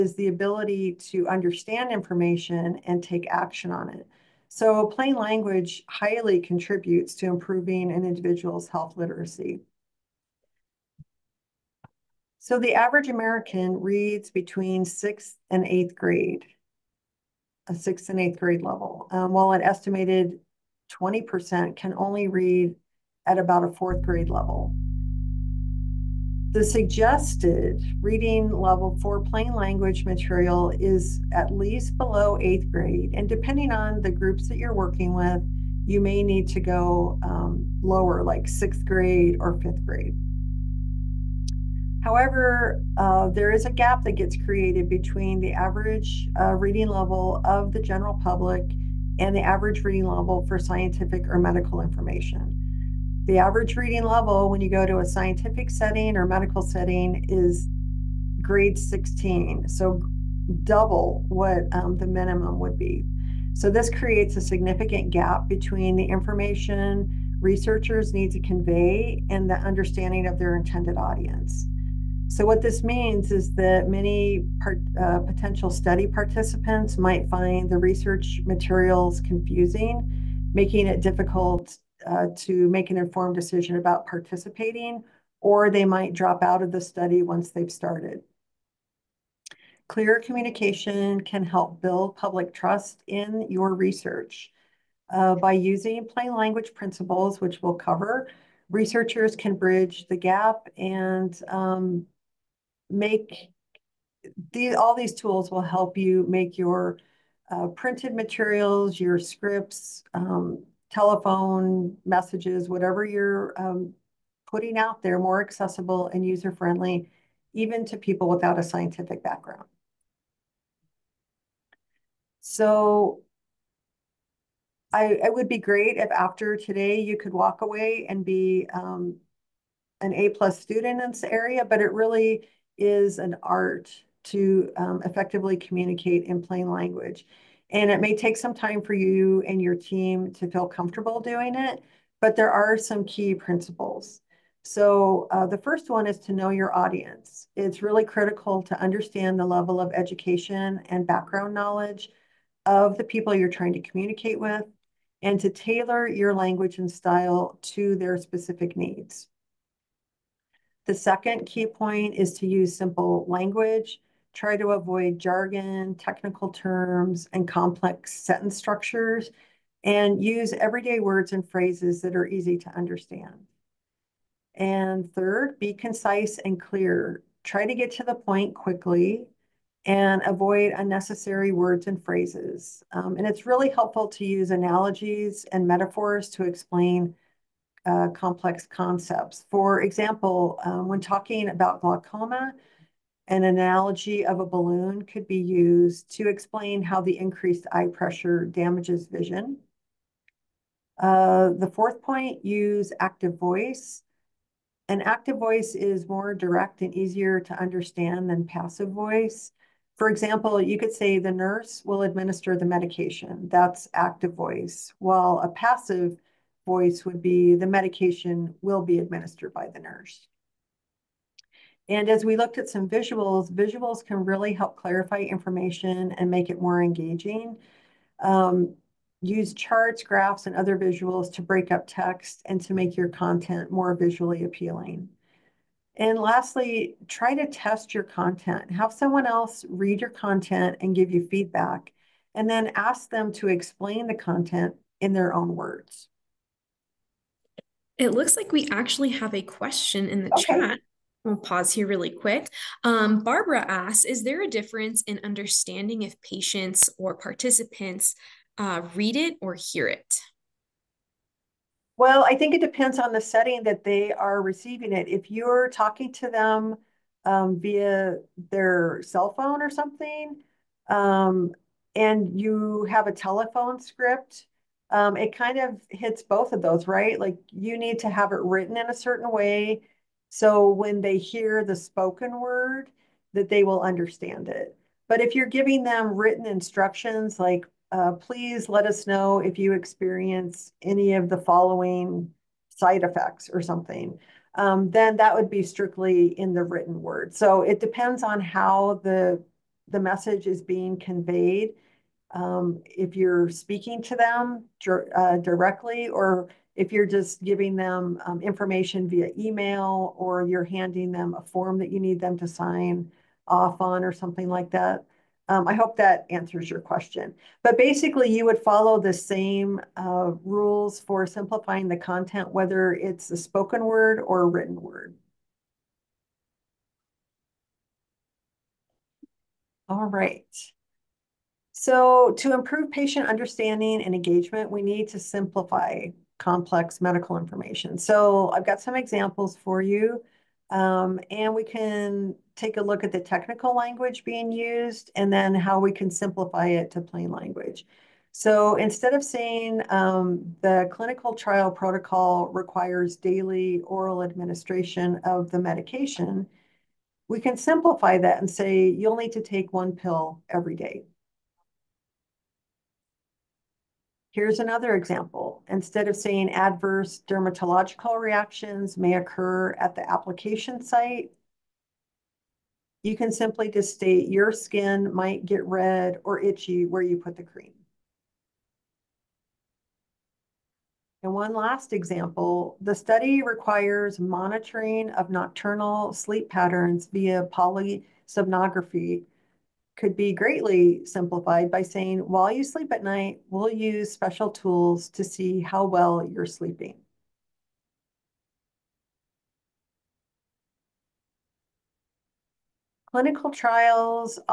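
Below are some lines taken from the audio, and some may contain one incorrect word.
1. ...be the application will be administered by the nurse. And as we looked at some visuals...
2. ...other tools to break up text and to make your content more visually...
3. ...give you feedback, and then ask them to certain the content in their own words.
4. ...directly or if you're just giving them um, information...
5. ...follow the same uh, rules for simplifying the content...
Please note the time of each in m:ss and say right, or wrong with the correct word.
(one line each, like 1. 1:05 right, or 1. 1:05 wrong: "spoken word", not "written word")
1. 3:37 wrong: "medication", not "application"
2. 3:50 wrong: "visuals", not "tools"
3. 4:00 wrong: "explain", not "certain"
4. 5:05 right
5. 5:18 right.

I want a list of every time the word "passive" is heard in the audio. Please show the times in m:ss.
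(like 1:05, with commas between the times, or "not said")
3:28, 3:35.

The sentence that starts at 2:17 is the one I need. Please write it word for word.
And it may take some time for you and your team to feel comfortable doing it, but there are some key principles.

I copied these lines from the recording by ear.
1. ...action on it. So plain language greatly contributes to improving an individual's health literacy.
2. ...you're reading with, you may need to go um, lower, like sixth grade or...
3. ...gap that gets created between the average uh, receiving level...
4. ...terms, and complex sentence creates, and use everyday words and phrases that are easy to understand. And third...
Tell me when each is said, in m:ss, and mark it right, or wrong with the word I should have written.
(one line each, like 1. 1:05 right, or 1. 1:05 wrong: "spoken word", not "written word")
1. 0:03 wrong: "highly", not "greatly"
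2. 0:34 wrong: "working", not "reading"
3. 0:43 wrong: "reading", not "receiving"
4. 2:46 wrong: "structures", not "creates".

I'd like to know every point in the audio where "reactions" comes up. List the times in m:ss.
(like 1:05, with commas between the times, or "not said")
6:08.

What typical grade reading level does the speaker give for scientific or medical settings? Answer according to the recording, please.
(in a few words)
grade 16.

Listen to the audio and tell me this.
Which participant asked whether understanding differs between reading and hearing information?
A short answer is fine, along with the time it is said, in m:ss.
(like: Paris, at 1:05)
Barbara, at 4:13.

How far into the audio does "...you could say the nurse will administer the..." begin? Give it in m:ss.
3:30.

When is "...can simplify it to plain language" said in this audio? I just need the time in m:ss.
5:45.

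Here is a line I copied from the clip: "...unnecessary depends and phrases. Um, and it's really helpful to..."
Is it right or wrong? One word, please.
wrong.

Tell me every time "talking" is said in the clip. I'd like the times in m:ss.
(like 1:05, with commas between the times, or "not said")
3:11, 4:25.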